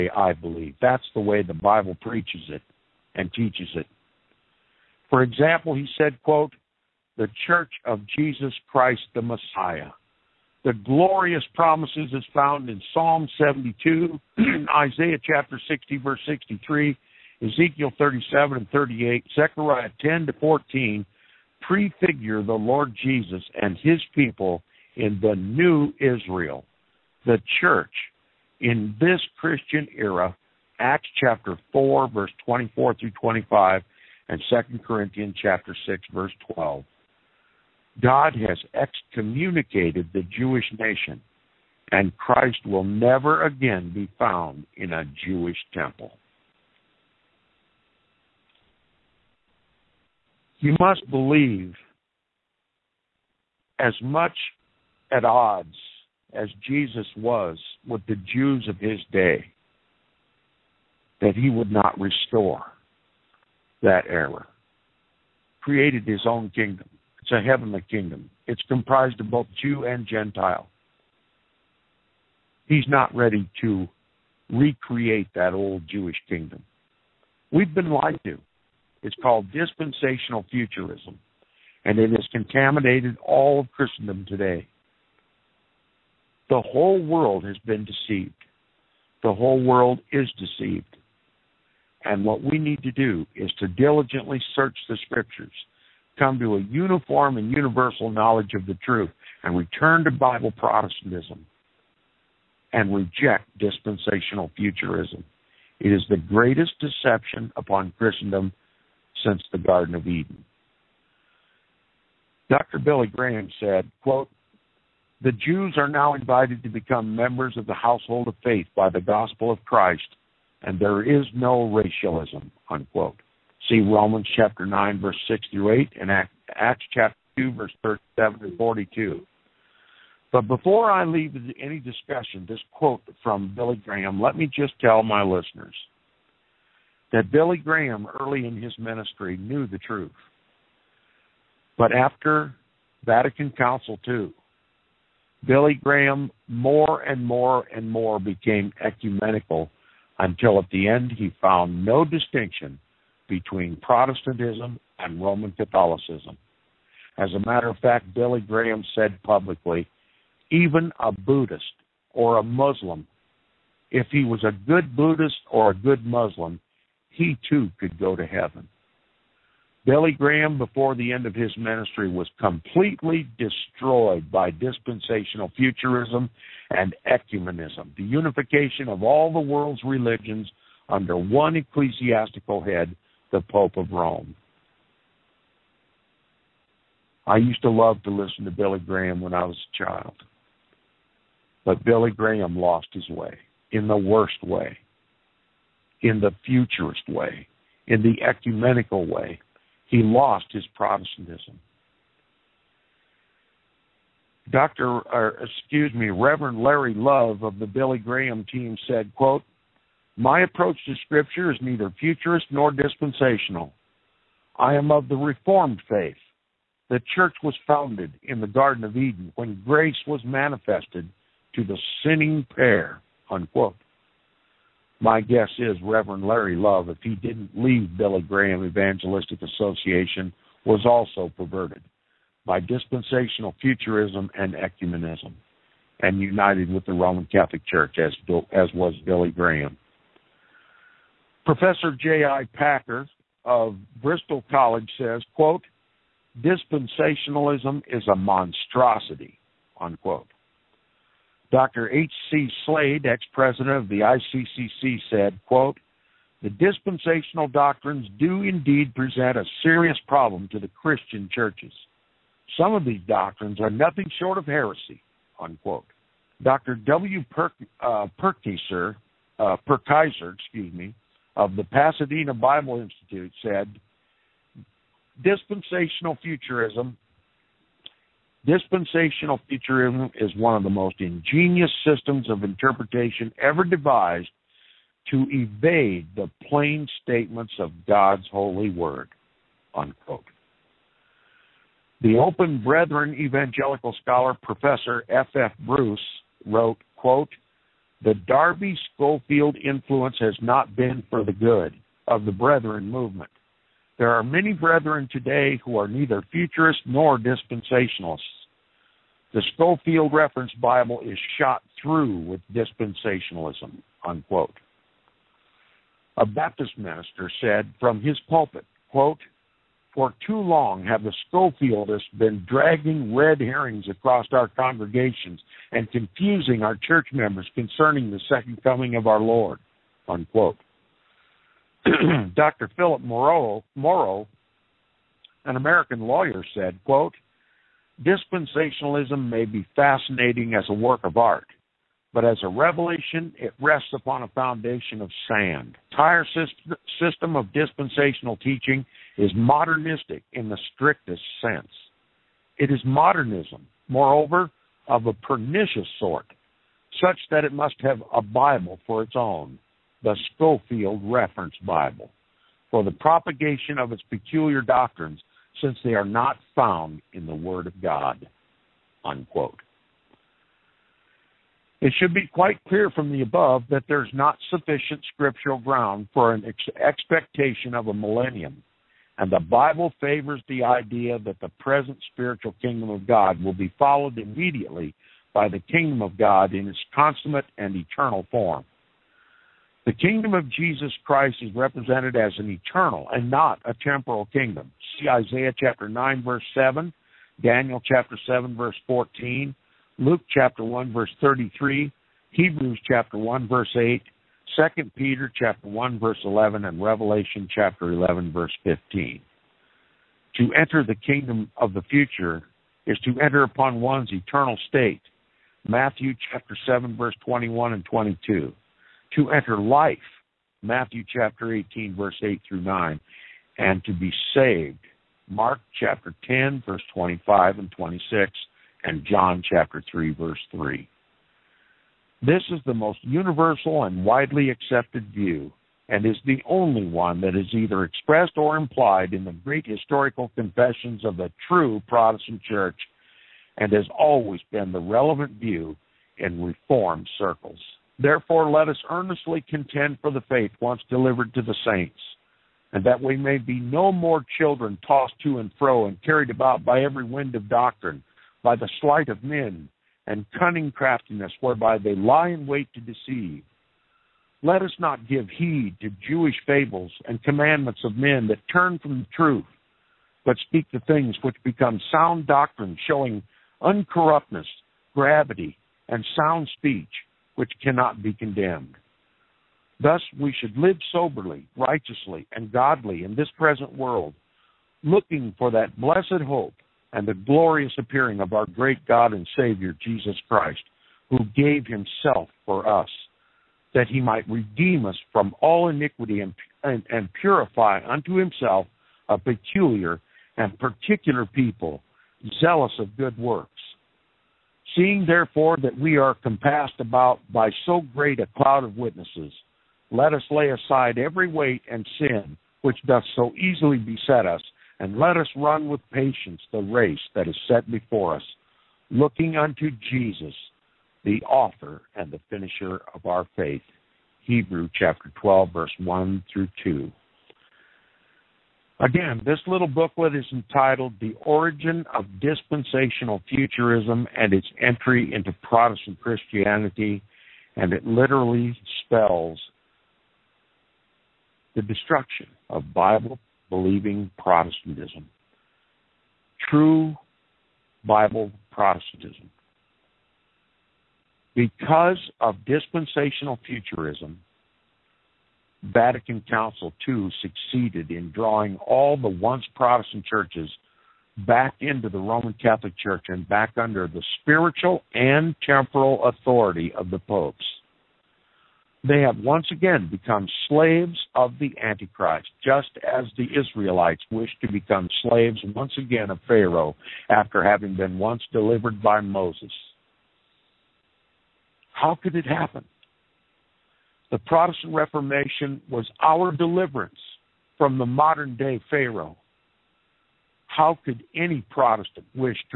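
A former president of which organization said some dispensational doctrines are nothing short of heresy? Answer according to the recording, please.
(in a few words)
ICCC.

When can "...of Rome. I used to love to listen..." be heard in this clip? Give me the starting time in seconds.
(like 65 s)
183 s.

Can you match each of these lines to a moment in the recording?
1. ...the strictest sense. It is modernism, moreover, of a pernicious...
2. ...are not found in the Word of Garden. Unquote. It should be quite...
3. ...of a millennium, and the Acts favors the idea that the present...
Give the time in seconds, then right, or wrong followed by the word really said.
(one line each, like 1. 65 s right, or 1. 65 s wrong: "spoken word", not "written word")
1. 350 s right
2. 365 s wrong: "God", not "Garden"
3. 377 s wrong: "Bible", not "Acts".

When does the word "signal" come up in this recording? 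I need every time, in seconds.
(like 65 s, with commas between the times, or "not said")
not said.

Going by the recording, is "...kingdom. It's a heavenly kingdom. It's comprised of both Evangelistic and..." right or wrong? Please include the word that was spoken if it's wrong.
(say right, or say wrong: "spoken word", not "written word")
wrong: "Jew", not "Evangelistic".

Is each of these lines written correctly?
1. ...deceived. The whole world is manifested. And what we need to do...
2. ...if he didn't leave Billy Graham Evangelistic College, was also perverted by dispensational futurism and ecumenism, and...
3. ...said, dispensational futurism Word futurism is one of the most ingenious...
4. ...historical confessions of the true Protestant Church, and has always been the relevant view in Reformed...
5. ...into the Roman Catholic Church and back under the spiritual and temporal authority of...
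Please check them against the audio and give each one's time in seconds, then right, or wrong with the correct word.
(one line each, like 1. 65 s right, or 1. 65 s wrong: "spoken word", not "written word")
1. 87 s wrong: "deceived", not "manifested"
2. 226 s wrong: "Association", not "College"
3. 273 s wrong: "Dispensational", not "Word"
4. 439 s right
5. 561 s right.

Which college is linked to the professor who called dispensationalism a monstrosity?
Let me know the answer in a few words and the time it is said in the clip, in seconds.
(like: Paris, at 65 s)
Bristol College, at 244 s.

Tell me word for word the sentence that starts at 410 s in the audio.
To enter the kingdom of the future is to enter upon one's eternal state.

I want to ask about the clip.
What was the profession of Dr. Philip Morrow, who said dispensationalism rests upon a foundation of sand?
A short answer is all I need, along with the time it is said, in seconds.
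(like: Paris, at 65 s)
Lawyer, at 336 s.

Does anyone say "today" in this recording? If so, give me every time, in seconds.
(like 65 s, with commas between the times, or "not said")
84 s, 305 s.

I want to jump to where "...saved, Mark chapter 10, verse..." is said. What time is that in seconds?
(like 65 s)
424 s.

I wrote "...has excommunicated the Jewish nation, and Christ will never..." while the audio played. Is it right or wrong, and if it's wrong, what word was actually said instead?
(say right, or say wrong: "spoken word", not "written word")
right.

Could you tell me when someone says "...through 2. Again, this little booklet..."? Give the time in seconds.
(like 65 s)
526 s.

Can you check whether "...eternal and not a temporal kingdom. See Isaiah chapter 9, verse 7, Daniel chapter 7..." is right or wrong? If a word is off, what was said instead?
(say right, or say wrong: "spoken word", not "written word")
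right.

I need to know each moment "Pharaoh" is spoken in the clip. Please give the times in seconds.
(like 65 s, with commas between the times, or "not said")
576 s, 588 s.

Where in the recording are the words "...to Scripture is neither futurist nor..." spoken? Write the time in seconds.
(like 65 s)
210 s.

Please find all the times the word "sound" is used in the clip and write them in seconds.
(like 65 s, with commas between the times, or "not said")
471 s, 476 s.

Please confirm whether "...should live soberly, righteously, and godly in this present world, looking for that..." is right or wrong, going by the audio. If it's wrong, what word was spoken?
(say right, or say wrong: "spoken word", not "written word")
right.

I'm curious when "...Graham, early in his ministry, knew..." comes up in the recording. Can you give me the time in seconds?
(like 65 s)
137 s.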